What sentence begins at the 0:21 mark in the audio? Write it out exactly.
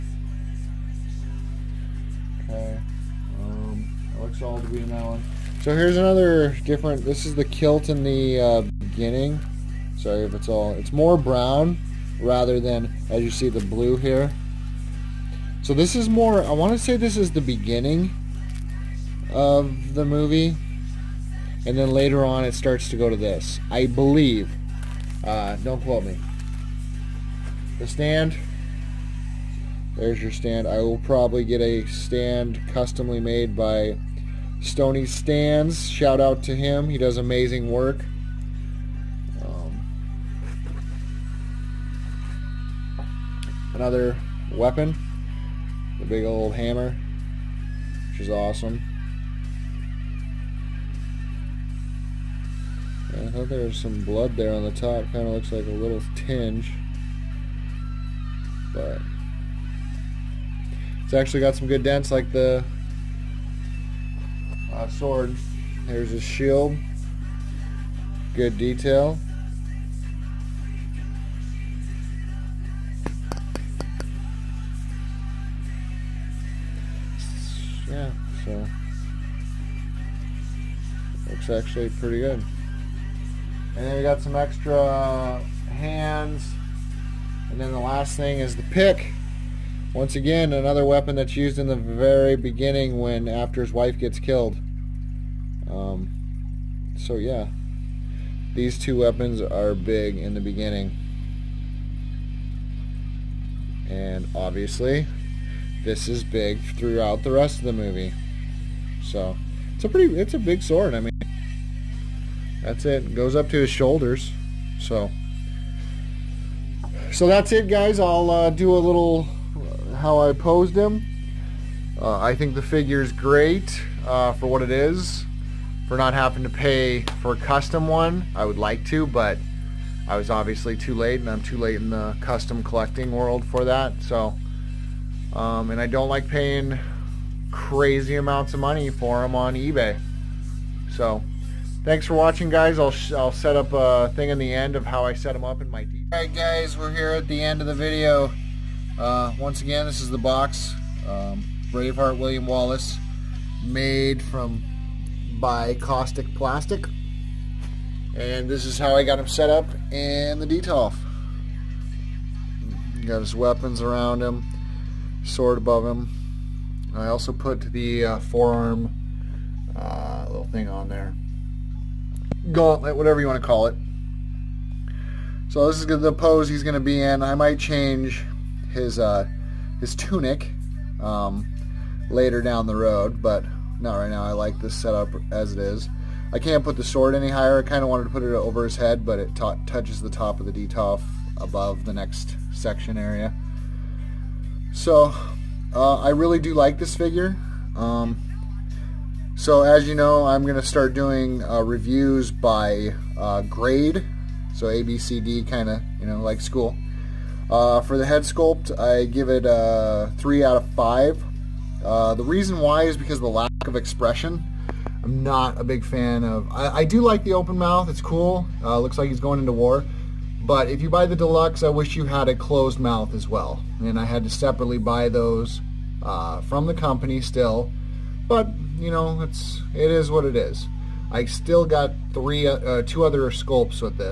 And then later on it starts to go to this.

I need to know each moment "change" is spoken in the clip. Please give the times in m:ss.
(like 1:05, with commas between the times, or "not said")
2:57.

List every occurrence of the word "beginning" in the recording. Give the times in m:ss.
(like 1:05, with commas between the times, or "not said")
0:08, 0:17, 1:32, 1:40.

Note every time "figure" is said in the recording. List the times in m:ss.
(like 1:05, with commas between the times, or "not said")
2:02, 3:16.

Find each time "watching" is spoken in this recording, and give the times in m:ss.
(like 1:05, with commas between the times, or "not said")
2:22.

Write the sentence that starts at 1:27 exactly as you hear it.
And then the last thing is the pick.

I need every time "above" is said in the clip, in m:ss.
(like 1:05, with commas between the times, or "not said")
2:45, 3:11.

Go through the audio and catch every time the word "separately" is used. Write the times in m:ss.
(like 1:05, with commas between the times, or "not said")
3:44.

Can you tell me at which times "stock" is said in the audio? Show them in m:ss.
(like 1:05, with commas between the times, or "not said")
not said.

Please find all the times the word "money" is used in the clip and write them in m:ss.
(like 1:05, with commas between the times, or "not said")
2:18.